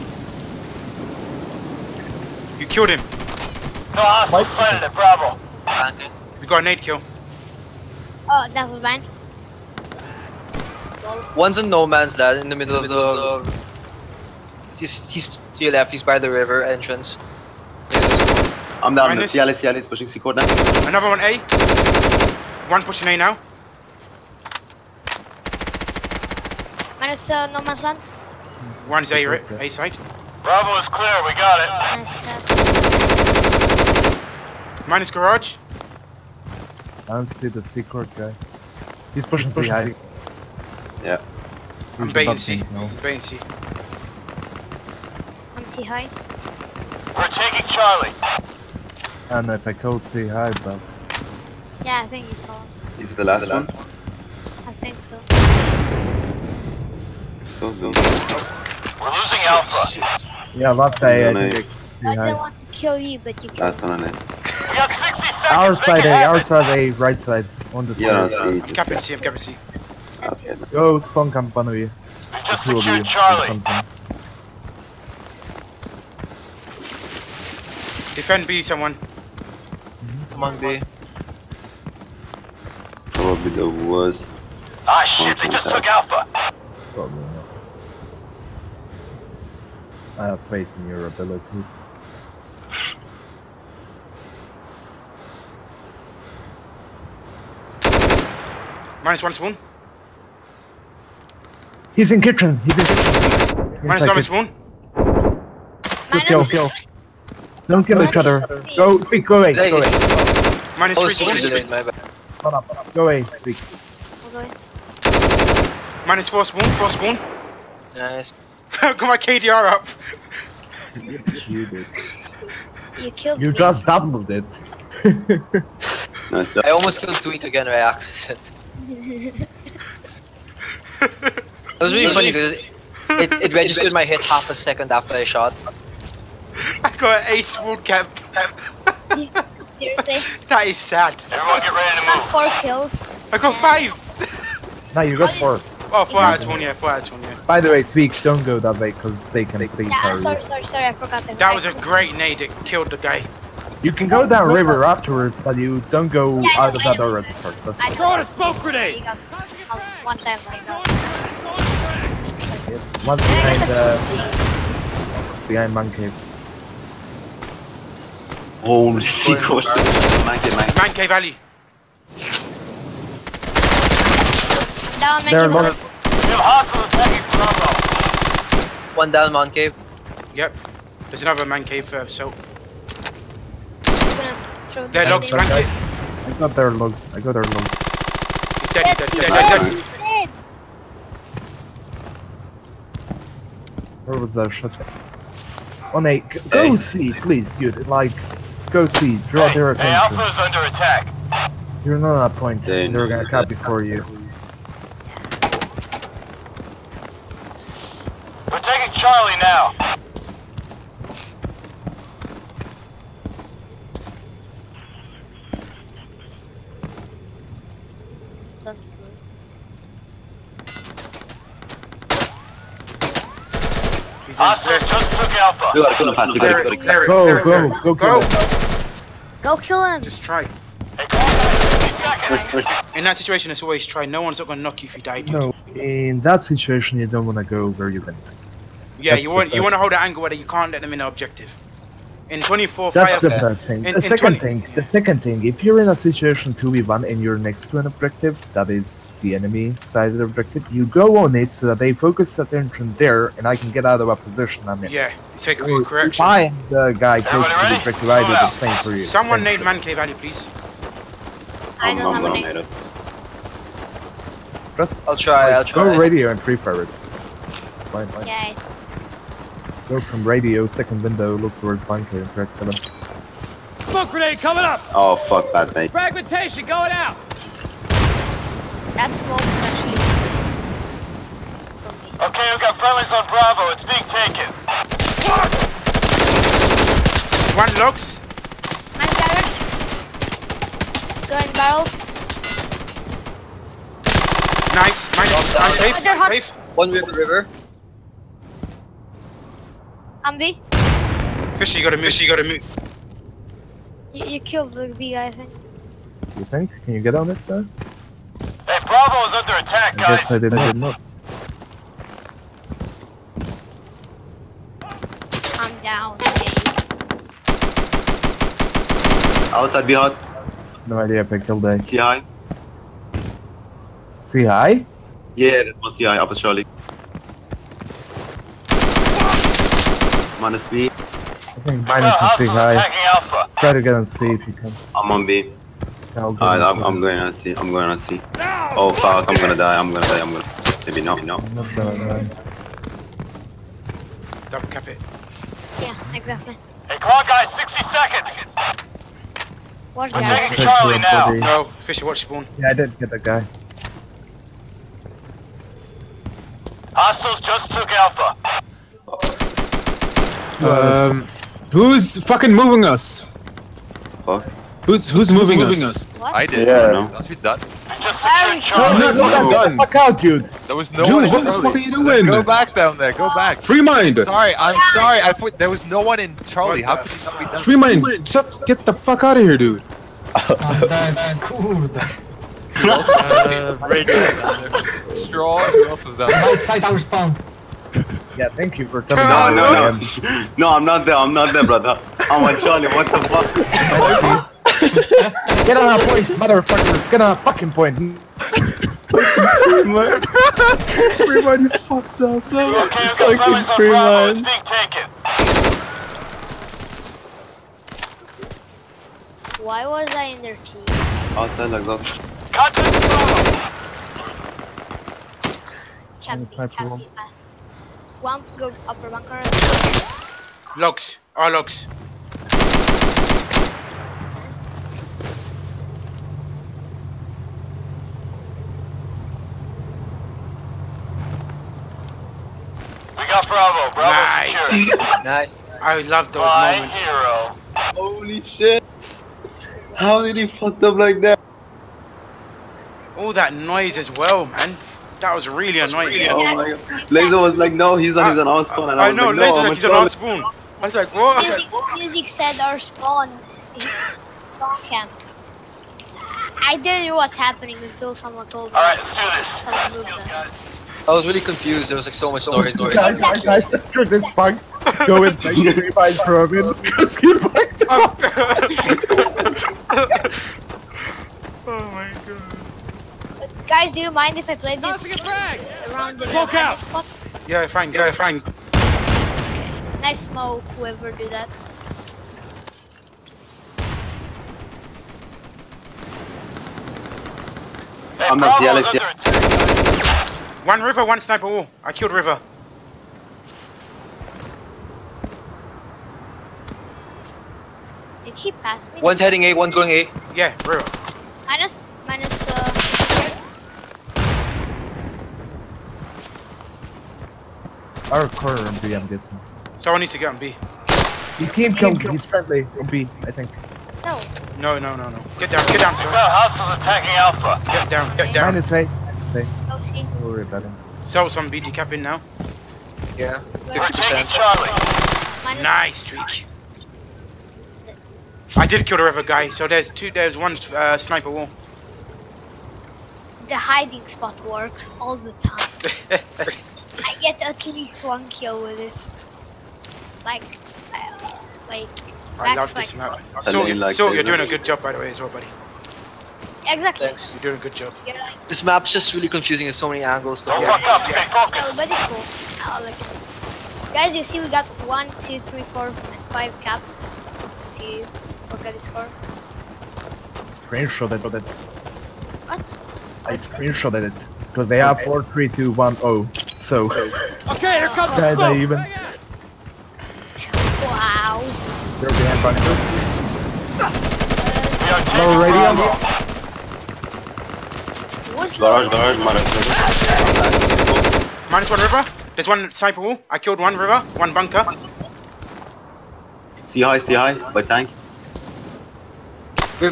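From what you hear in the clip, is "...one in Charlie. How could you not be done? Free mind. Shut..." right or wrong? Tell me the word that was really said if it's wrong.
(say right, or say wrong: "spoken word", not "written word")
right.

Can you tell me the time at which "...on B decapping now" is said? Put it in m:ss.
8:41.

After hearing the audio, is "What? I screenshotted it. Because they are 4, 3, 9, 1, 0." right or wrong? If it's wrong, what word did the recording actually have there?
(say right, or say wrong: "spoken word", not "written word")
wrong: "2", not "9".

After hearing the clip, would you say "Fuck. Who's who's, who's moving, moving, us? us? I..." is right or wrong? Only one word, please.
right.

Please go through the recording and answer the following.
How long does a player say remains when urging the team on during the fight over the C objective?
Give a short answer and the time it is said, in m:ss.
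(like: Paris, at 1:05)
60 seconds, at 5:47.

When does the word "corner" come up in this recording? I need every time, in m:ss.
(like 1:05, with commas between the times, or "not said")
8:28.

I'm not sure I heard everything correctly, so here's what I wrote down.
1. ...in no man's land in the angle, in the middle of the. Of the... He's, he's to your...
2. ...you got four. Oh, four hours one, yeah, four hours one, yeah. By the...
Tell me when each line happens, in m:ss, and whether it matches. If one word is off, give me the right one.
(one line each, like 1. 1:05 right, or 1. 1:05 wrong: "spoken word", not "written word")
1. 0:11 wrong: "middle", not "angle"
2. 2:25 right.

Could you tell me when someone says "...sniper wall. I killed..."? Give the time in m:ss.
9:42.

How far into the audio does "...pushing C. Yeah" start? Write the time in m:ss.
0:39.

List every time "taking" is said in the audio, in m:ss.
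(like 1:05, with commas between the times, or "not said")
0:47, 5:50.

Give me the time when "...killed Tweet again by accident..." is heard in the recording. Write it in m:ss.
2:07.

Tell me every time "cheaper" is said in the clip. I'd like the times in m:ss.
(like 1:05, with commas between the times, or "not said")
not said.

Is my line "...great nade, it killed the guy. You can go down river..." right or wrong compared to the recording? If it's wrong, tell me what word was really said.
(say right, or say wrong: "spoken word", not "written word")
right.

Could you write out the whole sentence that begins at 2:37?
That's I throw a smoke grenade!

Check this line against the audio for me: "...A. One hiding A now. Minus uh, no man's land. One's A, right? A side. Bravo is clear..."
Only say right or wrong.
wrong.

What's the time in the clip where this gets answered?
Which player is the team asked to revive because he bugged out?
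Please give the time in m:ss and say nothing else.
7:45.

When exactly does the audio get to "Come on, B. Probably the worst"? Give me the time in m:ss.
1:20.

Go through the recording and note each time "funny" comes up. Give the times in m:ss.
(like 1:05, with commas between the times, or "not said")
2:12.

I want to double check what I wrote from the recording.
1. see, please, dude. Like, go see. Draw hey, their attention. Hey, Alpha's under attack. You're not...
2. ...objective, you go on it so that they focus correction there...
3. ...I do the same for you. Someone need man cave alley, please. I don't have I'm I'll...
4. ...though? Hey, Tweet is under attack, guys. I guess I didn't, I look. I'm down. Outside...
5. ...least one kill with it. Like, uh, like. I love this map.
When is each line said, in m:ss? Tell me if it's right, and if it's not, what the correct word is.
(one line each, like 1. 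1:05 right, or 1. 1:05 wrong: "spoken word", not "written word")
1. 3:16 right
2. 4:10 wrong: "attention", not "correction"
3. 4:18 right
4. 5:07 wrong: "Bravo", not "Tweet"
5. 8:57 right.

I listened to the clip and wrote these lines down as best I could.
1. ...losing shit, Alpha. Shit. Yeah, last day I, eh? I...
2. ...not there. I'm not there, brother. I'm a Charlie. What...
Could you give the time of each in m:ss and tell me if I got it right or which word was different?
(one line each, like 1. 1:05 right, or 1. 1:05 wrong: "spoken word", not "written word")
1. 0:59 right
2. 6:30 right.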